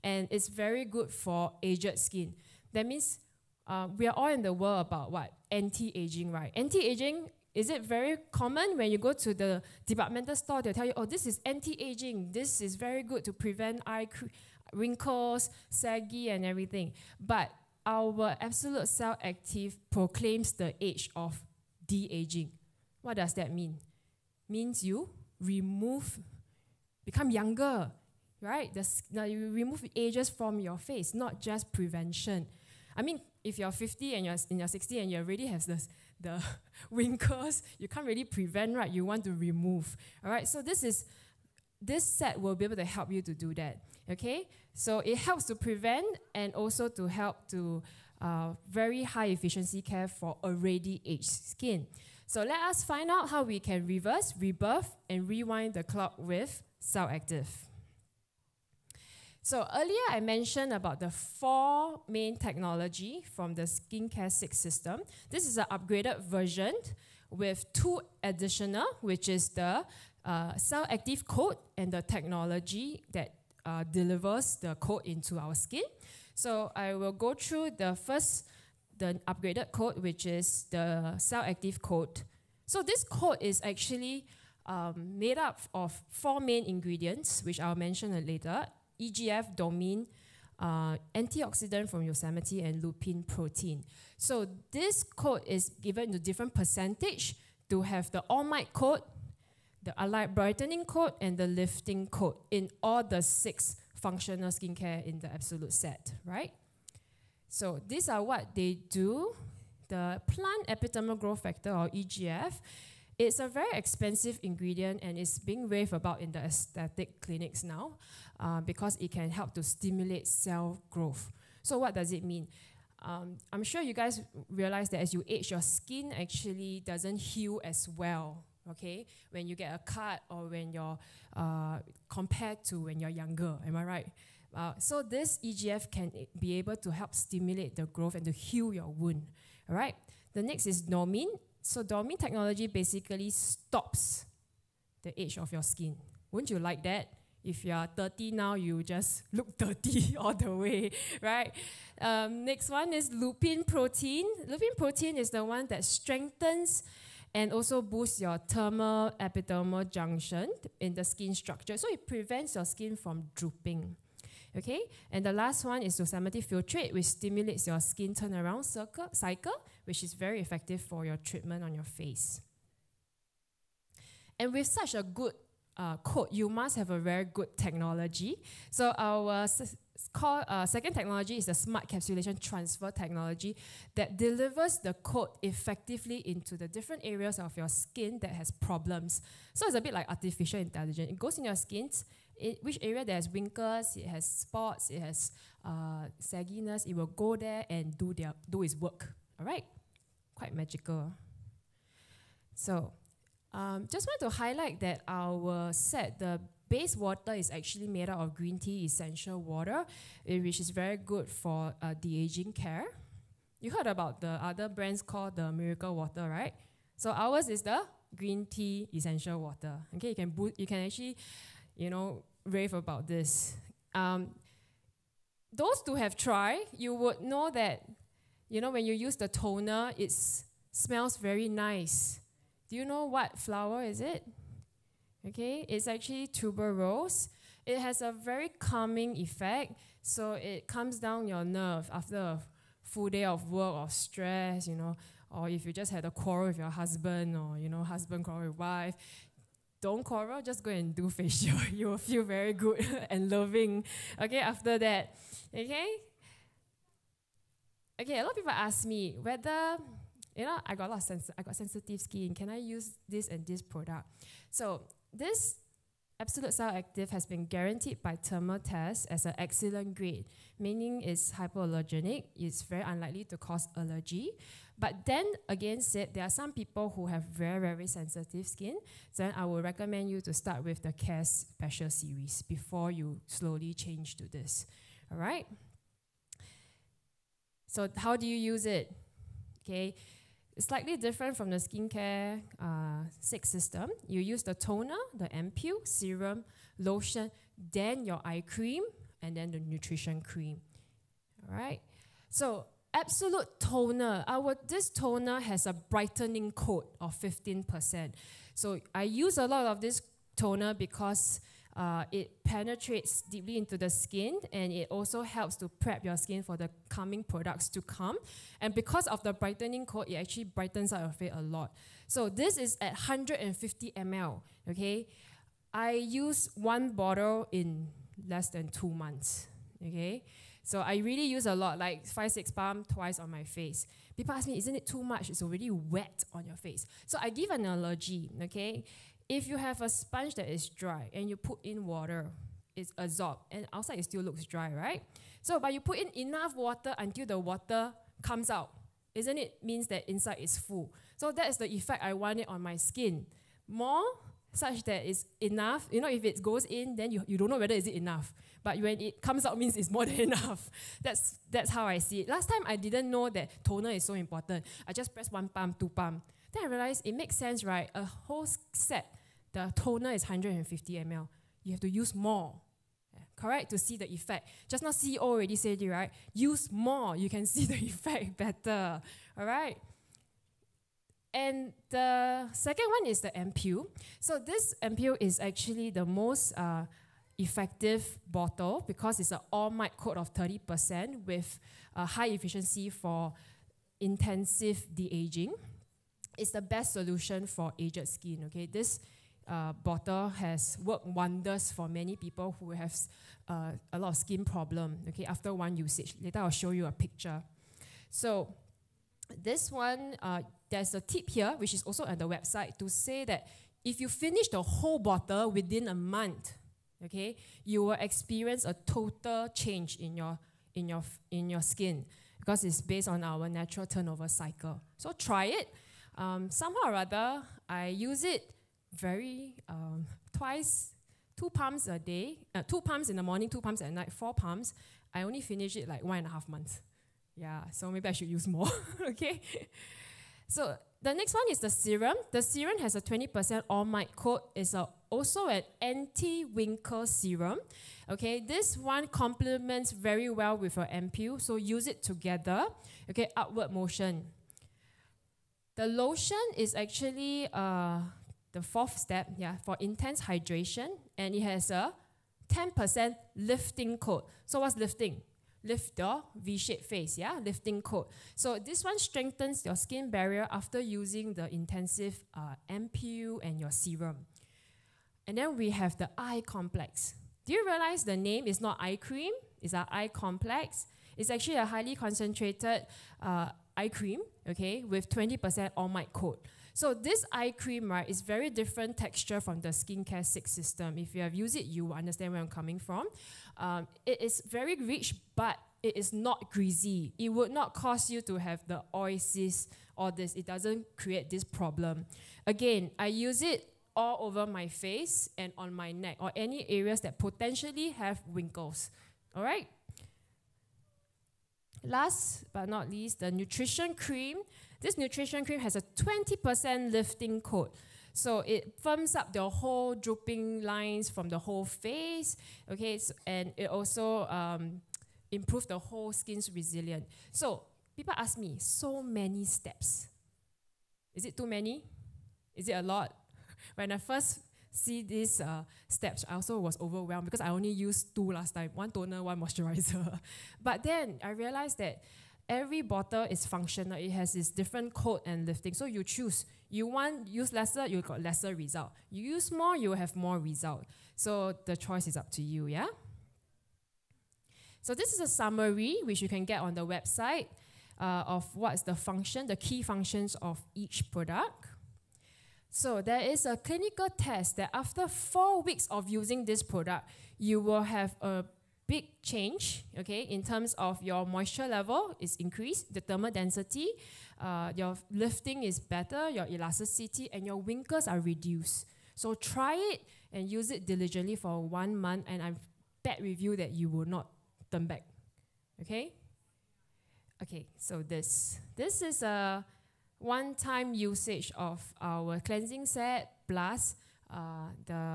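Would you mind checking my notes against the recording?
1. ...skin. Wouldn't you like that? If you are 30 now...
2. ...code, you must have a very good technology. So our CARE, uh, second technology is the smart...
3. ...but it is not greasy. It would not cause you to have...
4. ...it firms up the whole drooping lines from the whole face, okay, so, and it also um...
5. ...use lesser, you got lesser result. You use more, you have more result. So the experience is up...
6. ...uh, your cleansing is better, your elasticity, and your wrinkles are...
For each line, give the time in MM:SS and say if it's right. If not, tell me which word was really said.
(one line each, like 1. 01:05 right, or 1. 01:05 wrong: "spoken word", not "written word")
1. 02:25 right
2. 02:55 wrong: "Call", not "CARE"
3. 08:15 right
4. 08:38 right
5. 09:07 wrong: "choice", not "experience"
6. 09:34 wrong: "lifting", not "cleansing".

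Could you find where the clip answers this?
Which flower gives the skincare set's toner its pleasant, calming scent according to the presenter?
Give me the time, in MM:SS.
03:56.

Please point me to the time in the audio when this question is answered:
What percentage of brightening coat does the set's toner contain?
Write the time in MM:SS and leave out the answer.
05:07.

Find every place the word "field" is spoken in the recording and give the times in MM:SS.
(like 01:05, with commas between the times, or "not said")
not said.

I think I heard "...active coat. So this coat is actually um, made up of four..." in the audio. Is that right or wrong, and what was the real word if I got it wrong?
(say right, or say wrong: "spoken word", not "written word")
right.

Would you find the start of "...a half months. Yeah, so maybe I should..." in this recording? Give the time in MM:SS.
07:16.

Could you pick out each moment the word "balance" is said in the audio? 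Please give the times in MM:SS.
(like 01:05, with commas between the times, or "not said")
not said.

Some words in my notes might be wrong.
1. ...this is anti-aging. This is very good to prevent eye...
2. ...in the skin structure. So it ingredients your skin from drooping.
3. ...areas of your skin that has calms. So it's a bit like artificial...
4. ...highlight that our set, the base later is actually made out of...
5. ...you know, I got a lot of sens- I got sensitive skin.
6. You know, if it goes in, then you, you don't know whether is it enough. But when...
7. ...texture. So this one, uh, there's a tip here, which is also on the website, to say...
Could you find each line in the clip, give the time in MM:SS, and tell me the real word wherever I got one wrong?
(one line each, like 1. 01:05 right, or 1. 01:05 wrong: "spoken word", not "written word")
1. 00:11 right
2. 02:40 wrong: "prevents", not "ingredients"
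3. 03:07 wrong: "problems", not "calms"
4. 03:24 wrong: "water", not "later"
5. 04:20 right
6. 05:55 right
7. 06:46 wrong: "picture", not "texture".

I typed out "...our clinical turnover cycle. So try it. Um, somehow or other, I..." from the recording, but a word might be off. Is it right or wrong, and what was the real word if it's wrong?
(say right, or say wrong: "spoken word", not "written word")
wrong: "natural", not "clinical".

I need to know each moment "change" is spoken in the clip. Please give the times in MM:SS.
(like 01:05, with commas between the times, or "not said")
04:43, 06:59, 09:29.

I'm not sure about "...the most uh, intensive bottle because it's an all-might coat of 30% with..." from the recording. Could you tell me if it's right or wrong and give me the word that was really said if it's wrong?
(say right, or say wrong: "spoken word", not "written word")
wrong: "effective", not "intensive".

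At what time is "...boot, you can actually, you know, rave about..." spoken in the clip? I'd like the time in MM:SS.
03:40.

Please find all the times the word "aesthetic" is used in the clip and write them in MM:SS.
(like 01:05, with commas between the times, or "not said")
01:56.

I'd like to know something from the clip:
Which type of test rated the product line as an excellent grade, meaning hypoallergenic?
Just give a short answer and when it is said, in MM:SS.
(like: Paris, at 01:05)
Thermal test, at 04:28.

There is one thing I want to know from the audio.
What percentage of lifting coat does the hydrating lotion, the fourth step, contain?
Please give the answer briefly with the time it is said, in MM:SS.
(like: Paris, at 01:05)
10%, at 07:42.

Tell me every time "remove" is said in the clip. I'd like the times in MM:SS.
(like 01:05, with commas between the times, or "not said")
00:25, 00:29, 00:39.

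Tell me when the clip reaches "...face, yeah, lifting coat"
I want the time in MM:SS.
07:46.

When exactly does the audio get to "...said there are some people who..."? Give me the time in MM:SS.
04:35.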